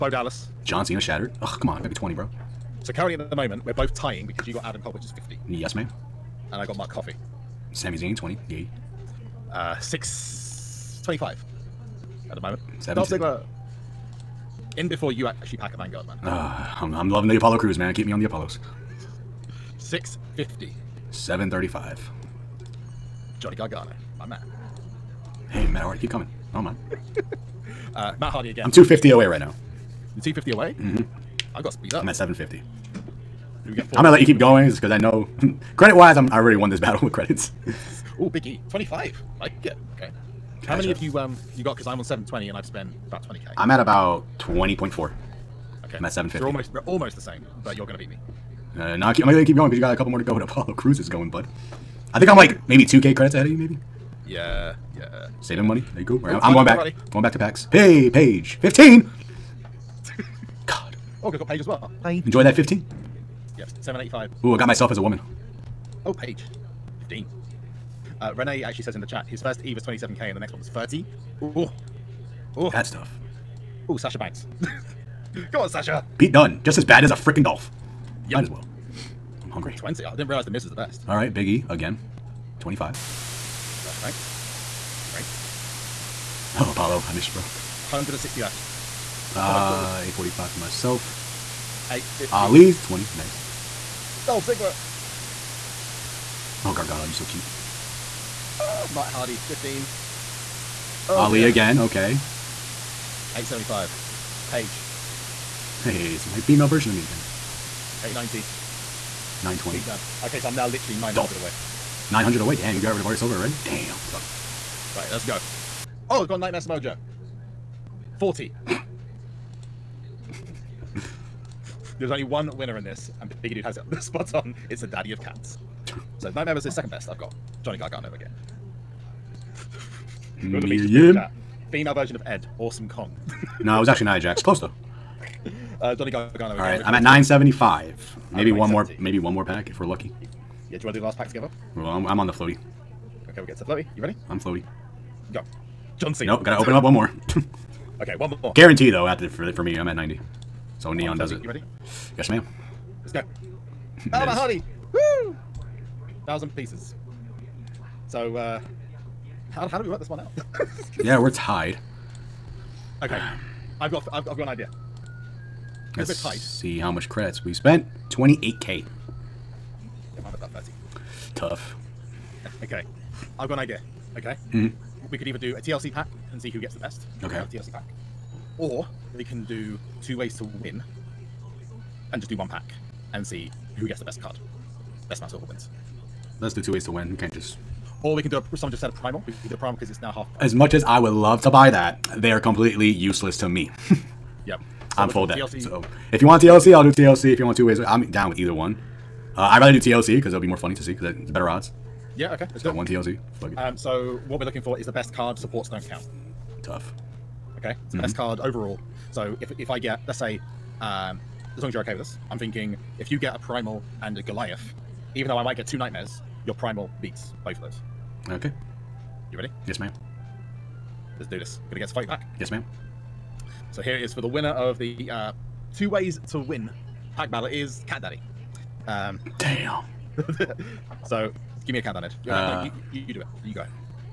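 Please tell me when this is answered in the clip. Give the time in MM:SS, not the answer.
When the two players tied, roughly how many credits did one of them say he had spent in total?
02:48.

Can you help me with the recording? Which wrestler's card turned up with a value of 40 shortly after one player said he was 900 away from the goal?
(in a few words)
Nightmare Samoa Joe.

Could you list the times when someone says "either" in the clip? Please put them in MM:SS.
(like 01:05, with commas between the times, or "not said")
02:55, 03:18.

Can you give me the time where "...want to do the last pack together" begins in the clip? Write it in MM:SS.
02:20.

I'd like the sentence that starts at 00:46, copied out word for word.
So we're almost we're almost the same, but you're gonna beat me.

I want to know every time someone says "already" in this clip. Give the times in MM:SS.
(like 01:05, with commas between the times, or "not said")
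00:36, 01:53.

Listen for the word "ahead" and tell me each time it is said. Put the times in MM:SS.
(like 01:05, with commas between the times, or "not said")
00:53, 03:53.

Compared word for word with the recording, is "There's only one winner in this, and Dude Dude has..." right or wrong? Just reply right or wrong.
wrong.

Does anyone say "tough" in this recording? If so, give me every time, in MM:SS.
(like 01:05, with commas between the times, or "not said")
01:12, 01:54, 02:51, 03:26.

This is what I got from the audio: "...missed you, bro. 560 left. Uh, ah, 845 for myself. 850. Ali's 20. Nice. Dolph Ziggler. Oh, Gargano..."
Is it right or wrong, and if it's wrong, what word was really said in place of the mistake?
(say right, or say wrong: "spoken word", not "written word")
wrong: "160", not "560".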